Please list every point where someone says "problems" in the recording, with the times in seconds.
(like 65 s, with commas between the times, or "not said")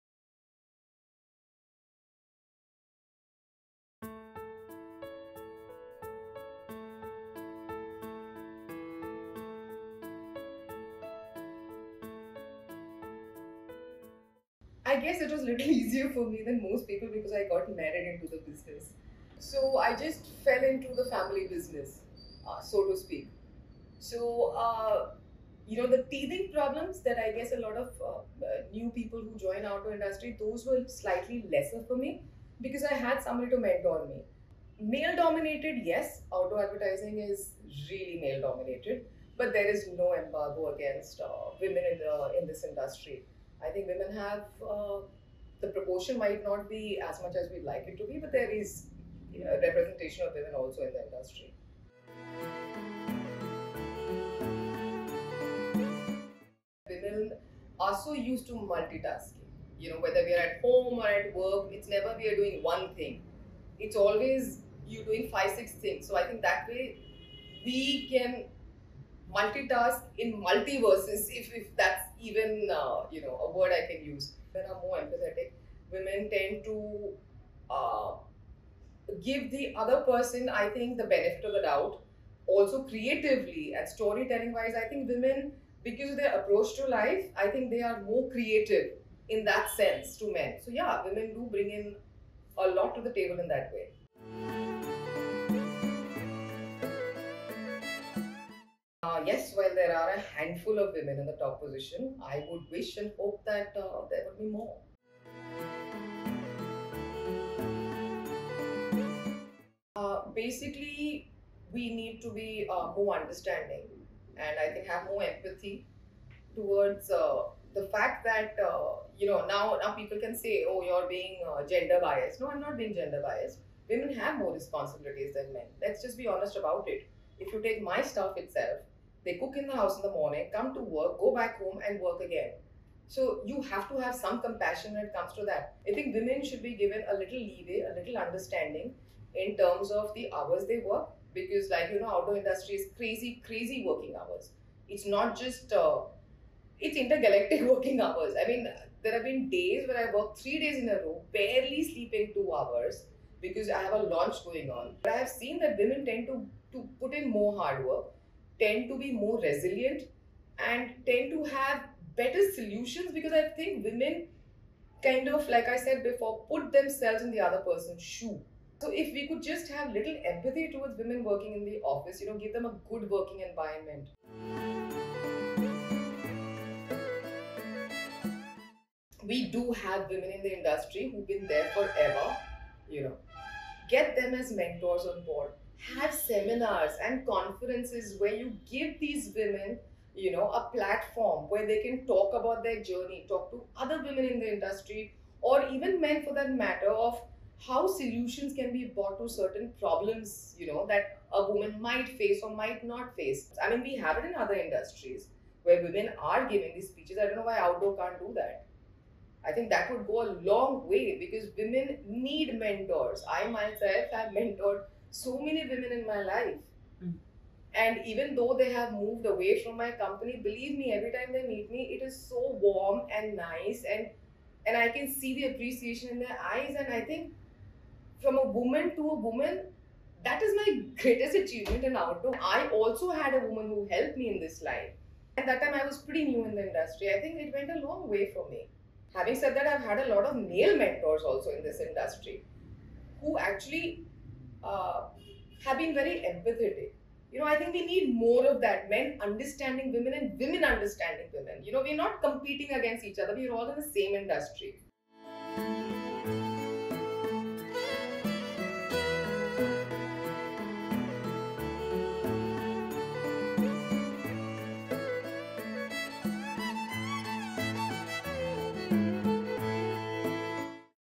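26 s, 199 s.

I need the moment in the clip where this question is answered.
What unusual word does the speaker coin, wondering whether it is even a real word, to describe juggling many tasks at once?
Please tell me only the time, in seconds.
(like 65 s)
70 s.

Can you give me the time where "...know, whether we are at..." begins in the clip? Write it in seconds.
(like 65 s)
59 s.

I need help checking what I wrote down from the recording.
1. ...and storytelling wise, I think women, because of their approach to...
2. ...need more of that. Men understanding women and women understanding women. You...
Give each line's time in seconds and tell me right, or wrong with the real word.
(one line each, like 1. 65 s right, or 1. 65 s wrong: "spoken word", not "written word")
1. 83 s right
2. 247 s right.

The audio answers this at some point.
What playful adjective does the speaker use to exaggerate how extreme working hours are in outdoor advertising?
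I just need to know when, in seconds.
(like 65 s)
146 s.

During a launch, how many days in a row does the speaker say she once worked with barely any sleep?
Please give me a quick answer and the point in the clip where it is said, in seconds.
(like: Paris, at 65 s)
3 days, at 150 s.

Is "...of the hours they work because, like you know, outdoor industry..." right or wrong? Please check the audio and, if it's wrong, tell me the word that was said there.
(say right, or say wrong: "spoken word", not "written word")
right.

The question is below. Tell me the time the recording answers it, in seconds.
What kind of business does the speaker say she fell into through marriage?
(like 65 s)
21 s.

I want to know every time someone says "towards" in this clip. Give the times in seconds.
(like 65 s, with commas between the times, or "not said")
116 s, 170 s.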